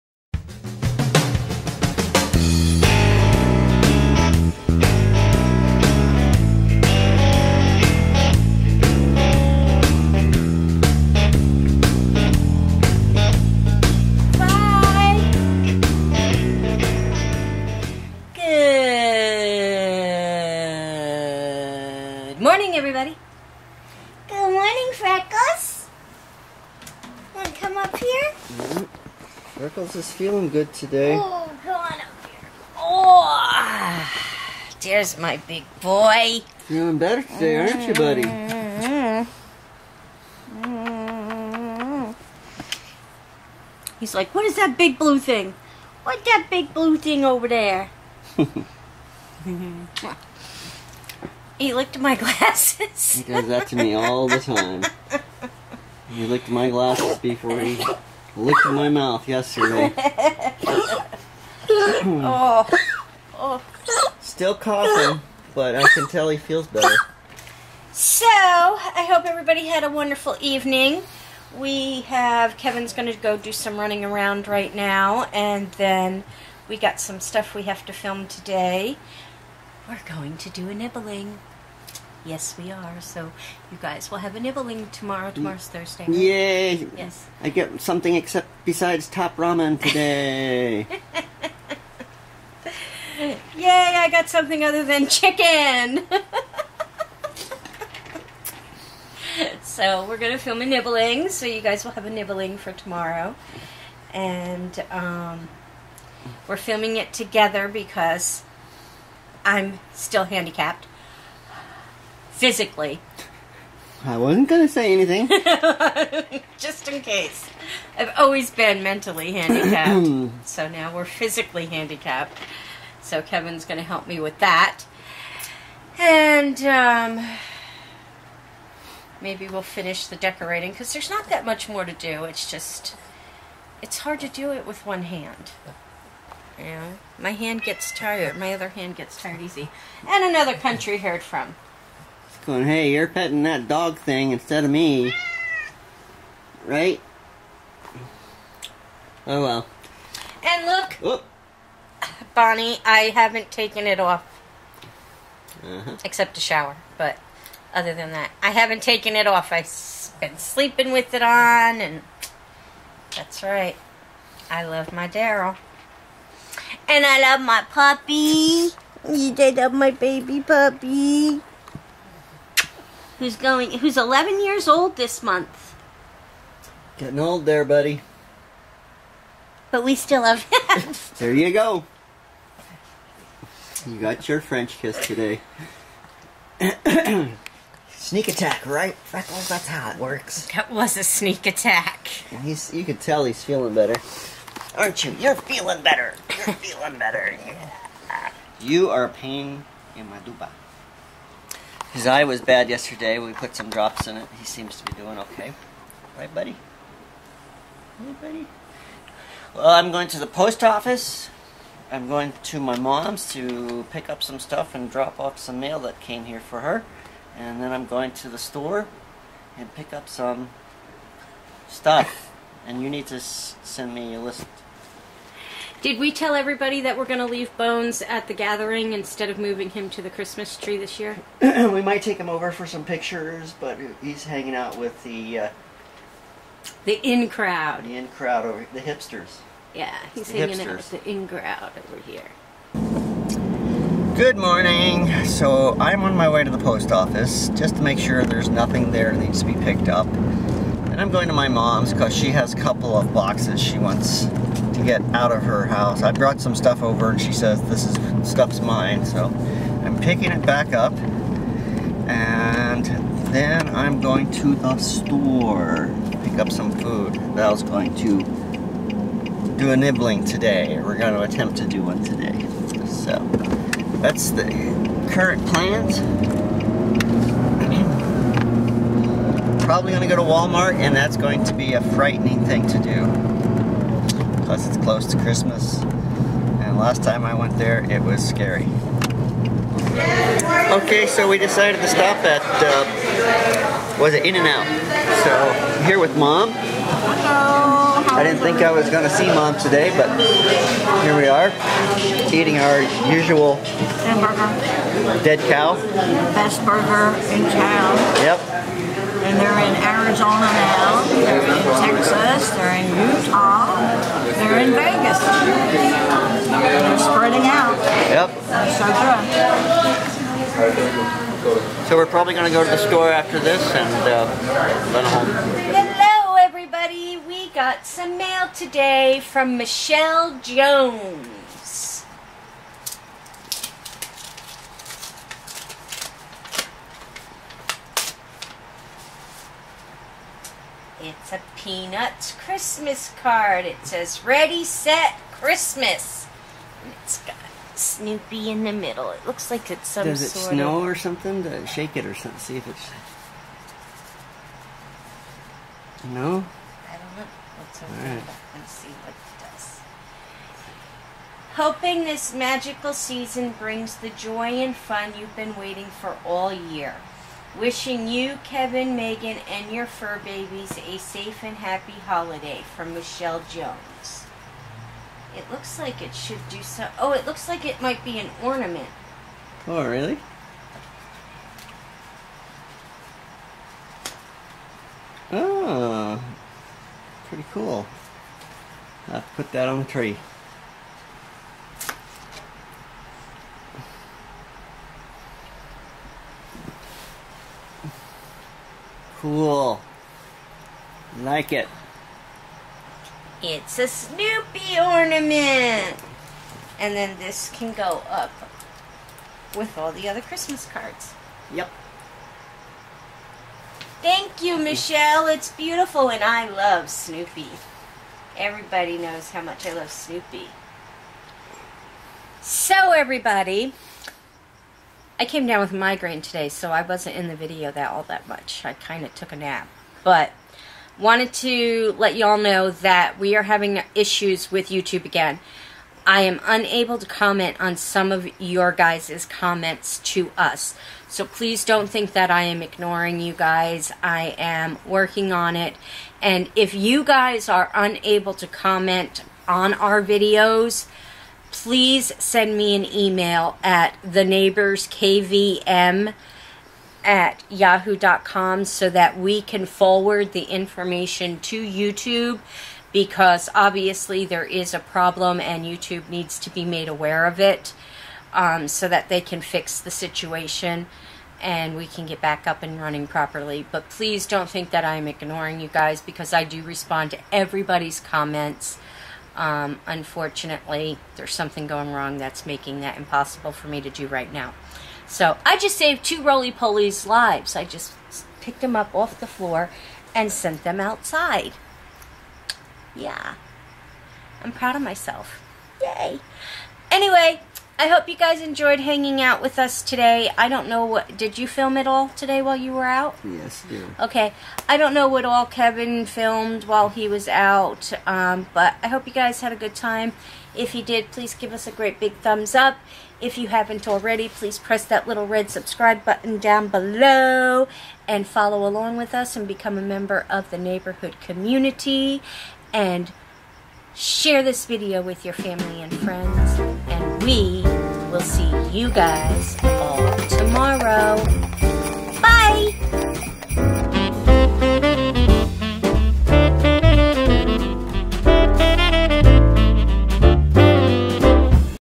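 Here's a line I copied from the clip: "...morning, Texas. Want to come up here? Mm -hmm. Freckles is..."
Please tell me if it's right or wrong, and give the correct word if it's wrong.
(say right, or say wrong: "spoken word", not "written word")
wrong: "Freckles", not "Texas".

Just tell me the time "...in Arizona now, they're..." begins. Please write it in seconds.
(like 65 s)
309 s.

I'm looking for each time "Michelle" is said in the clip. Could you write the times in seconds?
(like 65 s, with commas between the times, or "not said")
329 s, 372 s, 414 s.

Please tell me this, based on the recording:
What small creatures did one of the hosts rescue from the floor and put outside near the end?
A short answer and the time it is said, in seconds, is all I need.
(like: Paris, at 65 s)
Roly-polies, at 486 s.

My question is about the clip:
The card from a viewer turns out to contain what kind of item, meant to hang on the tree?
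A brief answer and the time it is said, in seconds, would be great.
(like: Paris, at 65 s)
A Snoopy ornament, at 403 s.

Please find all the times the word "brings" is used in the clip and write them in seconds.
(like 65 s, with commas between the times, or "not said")
363 s.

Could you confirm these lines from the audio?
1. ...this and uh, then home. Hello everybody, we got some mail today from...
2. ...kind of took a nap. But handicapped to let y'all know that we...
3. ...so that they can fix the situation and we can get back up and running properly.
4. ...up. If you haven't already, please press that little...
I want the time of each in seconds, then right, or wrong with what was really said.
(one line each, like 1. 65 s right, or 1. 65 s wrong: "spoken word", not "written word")
1. 323 s right
2. 428 s wrong: "wanted", not "handicapped"
3. 468 s right
4. 512 s right.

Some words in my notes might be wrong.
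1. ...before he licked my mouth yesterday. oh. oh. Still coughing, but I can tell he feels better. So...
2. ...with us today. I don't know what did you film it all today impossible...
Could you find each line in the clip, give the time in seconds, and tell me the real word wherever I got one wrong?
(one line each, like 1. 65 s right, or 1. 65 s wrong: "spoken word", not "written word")
1. 57 s right
2. 499 s wrong: "while", not "impossible".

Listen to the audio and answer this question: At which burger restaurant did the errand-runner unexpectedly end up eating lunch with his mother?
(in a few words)
In-N-Out.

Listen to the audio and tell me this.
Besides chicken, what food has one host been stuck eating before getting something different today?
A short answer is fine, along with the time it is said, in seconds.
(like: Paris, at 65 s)
Top ramen, at 89 s.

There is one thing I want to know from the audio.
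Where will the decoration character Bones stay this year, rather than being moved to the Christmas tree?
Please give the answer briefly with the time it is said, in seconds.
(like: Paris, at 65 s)
The gathering, at 228 s.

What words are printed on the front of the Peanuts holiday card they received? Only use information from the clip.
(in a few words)
Ready, Set, Christmas.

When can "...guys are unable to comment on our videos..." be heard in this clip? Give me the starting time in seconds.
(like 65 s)
447 s.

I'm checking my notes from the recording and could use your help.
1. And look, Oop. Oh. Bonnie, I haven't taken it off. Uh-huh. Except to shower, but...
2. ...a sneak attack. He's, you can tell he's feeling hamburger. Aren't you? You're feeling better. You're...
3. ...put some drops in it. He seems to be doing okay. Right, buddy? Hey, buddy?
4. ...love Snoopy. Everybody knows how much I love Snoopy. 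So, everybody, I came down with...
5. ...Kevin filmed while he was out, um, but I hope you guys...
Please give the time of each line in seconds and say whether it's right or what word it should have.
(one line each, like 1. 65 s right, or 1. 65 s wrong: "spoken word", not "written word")
1. 150 s right
2. 190 s wrong: "better", not "hamburger"
3. 203 s right
4. 416 s right
5. 505 s right.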